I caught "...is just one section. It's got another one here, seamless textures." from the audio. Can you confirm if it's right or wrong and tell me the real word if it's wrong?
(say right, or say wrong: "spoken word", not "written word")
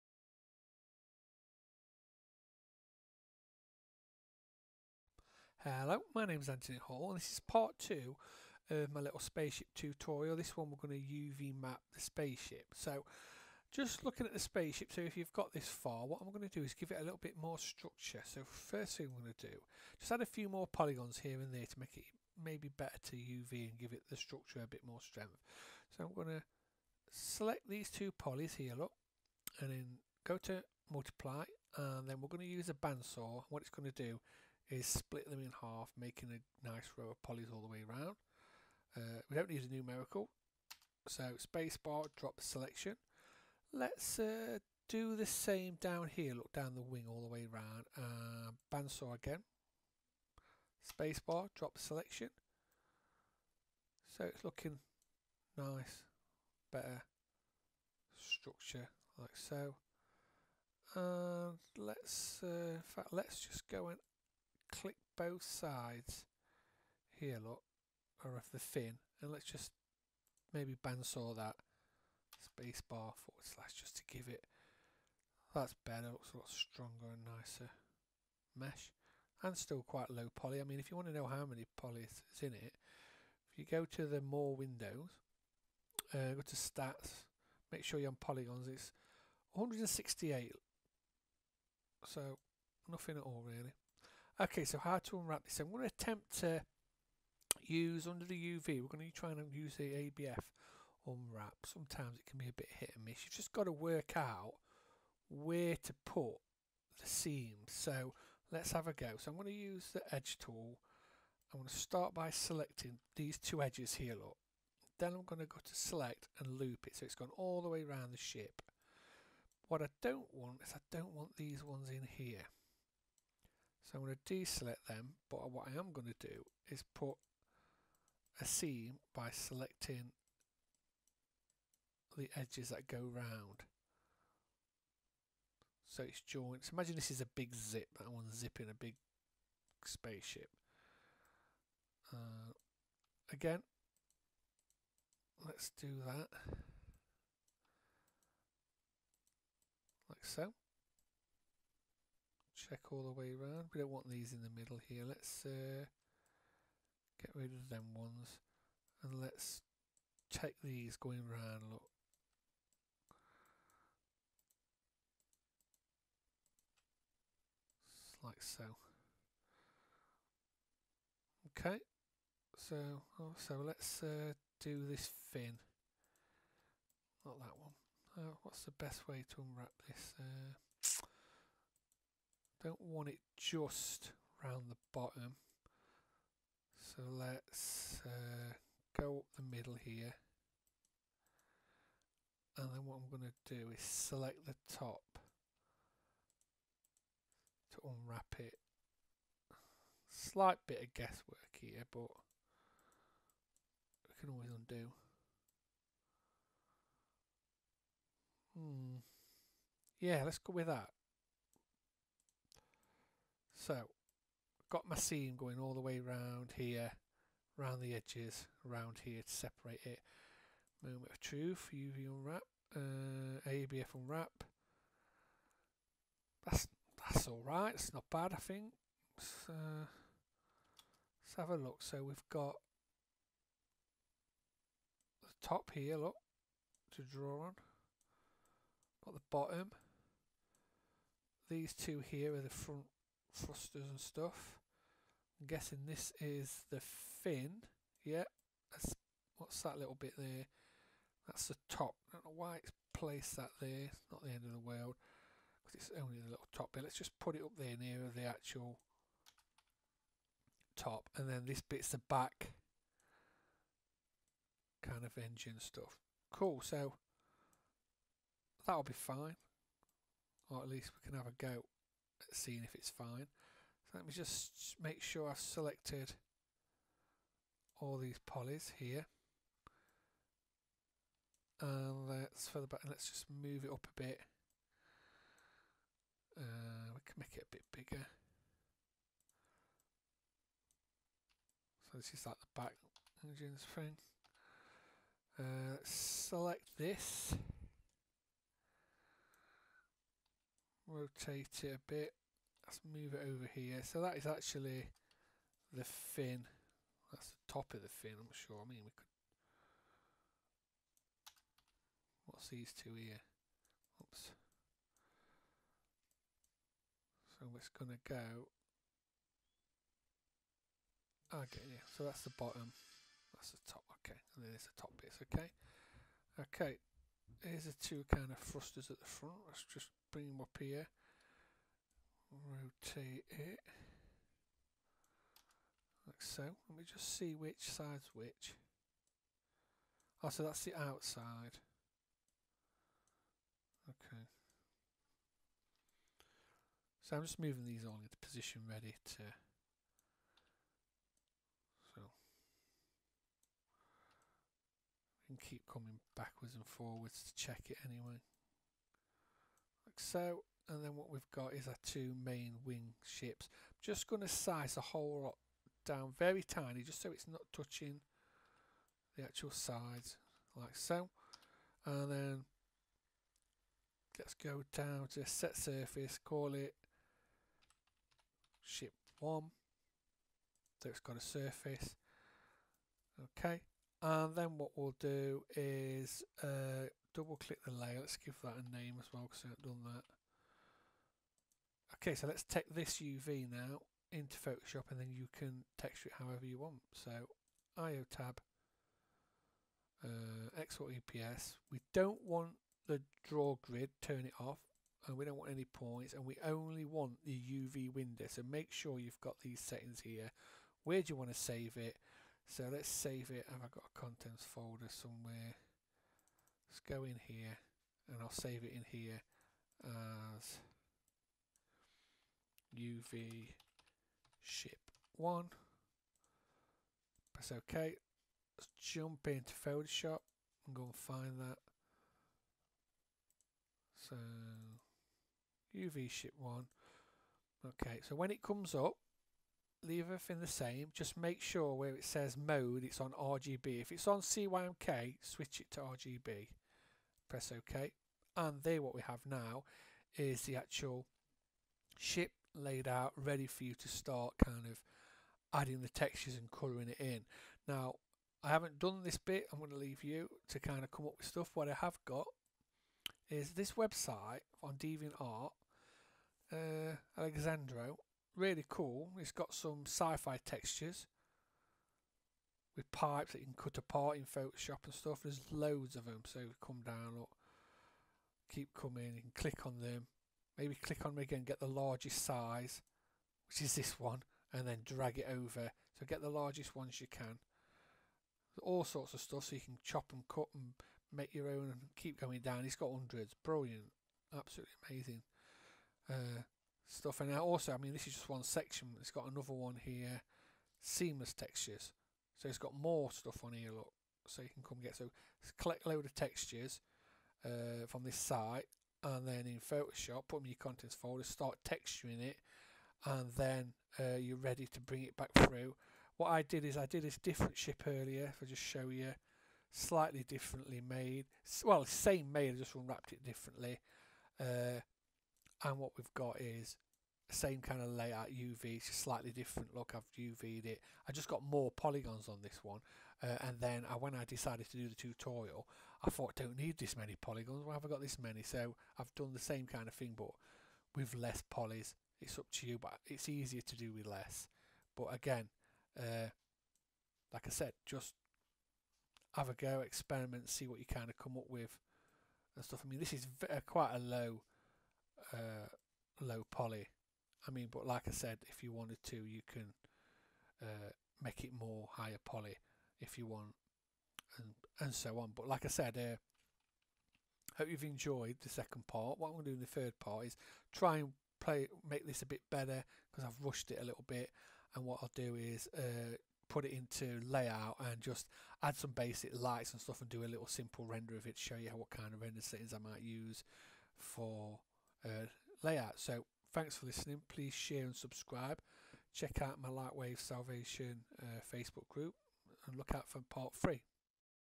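right.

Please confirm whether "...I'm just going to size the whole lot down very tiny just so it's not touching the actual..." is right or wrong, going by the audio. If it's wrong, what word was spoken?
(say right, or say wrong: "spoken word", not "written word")
right.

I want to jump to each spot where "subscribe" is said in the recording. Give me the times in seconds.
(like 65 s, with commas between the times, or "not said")
587 s.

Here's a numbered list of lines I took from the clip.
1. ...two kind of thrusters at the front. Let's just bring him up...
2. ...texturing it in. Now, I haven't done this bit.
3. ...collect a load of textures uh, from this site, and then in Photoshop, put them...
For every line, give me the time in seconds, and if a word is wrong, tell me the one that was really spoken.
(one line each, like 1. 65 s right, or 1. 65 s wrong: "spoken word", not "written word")
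1. 327 s right
2. 456 s wrong: "colouring", not "texturing"
3. 505 s right.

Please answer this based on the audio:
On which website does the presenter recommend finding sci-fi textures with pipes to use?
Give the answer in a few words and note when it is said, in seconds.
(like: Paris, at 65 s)
DeviantArt, at 464 s.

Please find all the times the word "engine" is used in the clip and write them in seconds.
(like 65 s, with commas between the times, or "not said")
265 s, 293 s.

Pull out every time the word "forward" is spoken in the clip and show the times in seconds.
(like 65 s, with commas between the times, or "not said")
73 s, 356 s.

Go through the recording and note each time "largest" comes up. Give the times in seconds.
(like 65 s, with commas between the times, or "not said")
481 s, 486 s.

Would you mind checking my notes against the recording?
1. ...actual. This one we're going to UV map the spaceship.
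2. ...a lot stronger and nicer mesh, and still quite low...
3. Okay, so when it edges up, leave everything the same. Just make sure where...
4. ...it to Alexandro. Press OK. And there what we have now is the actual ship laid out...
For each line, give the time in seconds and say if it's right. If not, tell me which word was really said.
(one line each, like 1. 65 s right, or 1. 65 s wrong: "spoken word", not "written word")
1. 9 s wrong: "tutorial", not "actual"
2. 76 s right
3. 437 s wrong: "comes", not "edges"
4. 445 s wrong: "RGB", not "Alexandro".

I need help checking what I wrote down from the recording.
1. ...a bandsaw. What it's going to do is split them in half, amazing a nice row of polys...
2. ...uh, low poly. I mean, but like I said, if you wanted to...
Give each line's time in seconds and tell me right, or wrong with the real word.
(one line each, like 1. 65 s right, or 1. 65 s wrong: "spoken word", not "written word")
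1. 32 s wrong: "making", not "amazing"
2. 555 s right.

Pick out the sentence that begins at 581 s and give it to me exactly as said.
Show you what kind of render settings I might use for uh, layout.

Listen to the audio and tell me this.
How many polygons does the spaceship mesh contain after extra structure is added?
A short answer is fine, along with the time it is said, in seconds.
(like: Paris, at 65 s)
168, at 89 s.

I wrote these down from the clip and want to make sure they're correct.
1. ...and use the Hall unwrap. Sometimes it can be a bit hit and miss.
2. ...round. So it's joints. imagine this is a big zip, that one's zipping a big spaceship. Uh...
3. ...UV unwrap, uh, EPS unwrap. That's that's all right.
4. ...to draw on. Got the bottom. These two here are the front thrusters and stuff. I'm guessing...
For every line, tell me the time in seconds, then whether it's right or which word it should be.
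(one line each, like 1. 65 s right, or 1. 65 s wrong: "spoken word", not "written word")
1. 99 s wrong: "ABF", not "Hall"
2. 132 s right
3. 221 s wrong: "ABF", not "EPS"
4. 236 s right.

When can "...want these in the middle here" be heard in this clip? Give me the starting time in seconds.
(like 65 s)
153 s.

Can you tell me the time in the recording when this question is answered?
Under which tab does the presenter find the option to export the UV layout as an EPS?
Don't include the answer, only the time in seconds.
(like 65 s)
397 s.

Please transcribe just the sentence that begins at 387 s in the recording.
Let's give that a name as well because I haven't done that.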